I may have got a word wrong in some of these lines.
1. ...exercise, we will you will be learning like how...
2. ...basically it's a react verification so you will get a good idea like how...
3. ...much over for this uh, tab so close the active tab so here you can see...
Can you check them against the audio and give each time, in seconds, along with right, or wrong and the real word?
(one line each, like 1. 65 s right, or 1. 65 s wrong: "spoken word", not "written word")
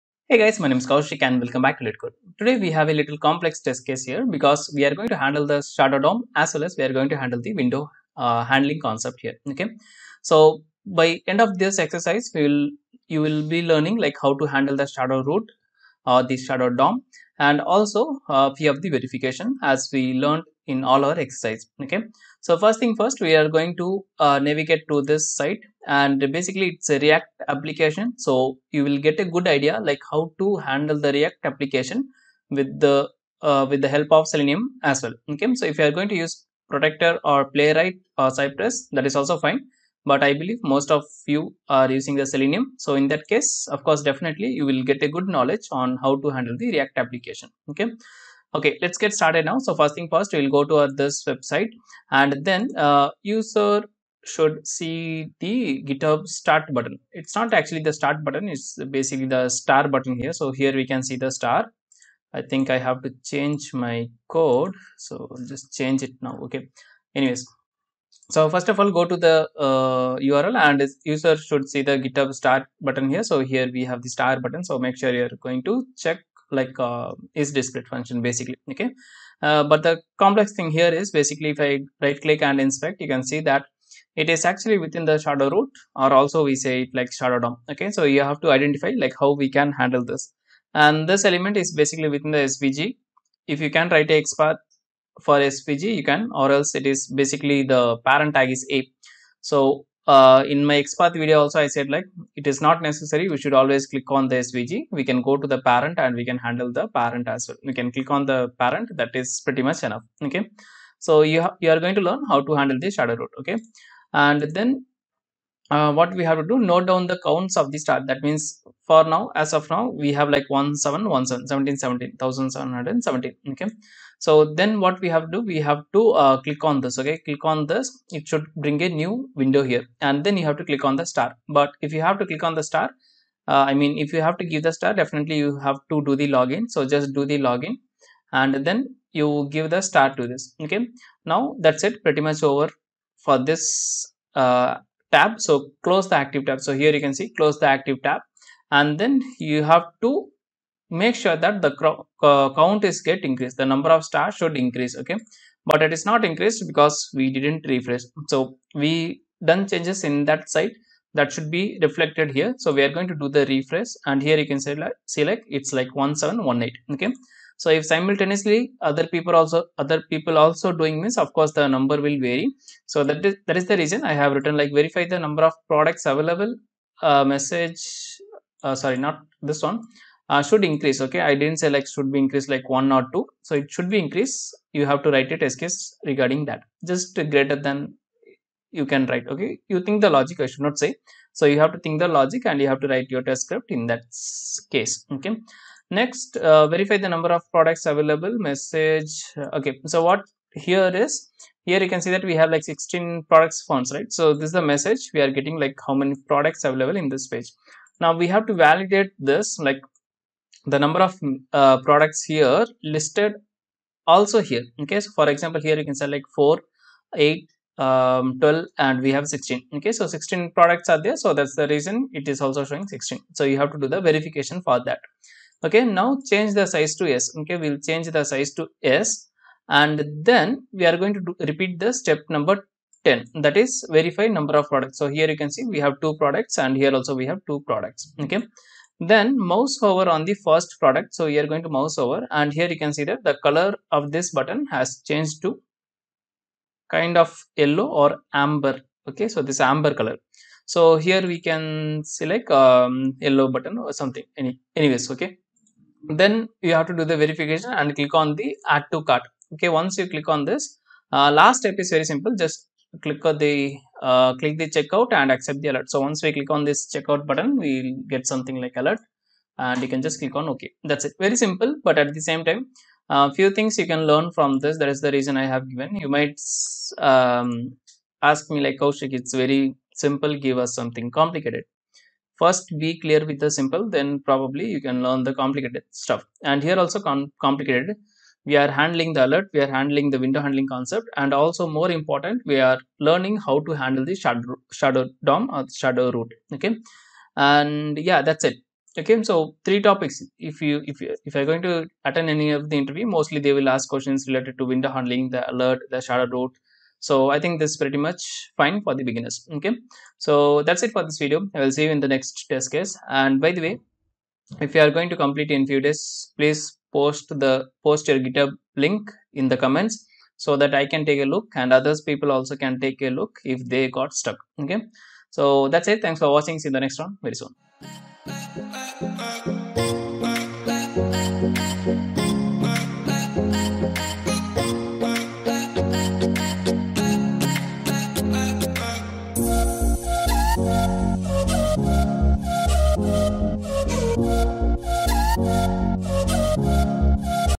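1. 11 s right
2. 26 s wrong: "application", not "verification"
3. 142 s right.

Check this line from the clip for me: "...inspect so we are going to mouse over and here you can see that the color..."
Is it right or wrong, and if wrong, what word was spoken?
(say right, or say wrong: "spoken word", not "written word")
wrong: "product", not "inspect".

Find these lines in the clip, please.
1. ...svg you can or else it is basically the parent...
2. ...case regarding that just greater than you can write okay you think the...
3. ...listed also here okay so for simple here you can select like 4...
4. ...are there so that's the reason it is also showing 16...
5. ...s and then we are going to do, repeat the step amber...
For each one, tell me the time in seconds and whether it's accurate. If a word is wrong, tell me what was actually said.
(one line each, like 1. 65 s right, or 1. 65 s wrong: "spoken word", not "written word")
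1. 95 s right
2. 185 s right
3. 212 s wrong: "example", not "simple"
4. 220 s right
5. 228 s wrong: "number", not "amber".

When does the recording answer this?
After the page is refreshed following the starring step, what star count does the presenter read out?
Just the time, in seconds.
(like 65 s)
165 s.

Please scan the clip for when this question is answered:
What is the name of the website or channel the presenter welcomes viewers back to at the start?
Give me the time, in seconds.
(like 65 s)
1 s.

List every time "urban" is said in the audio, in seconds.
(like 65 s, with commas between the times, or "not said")
not said.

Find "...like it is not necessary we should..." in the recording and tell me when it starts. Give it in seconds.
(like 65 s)
101 s.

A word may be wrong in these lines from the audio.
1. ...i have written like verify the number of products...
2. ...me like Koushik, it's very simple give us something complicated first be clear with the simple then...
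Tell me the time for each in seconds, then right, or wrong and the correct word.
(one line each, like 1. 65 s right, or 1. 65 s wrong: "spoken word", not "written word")
1. 174 s right
2. 278 s right.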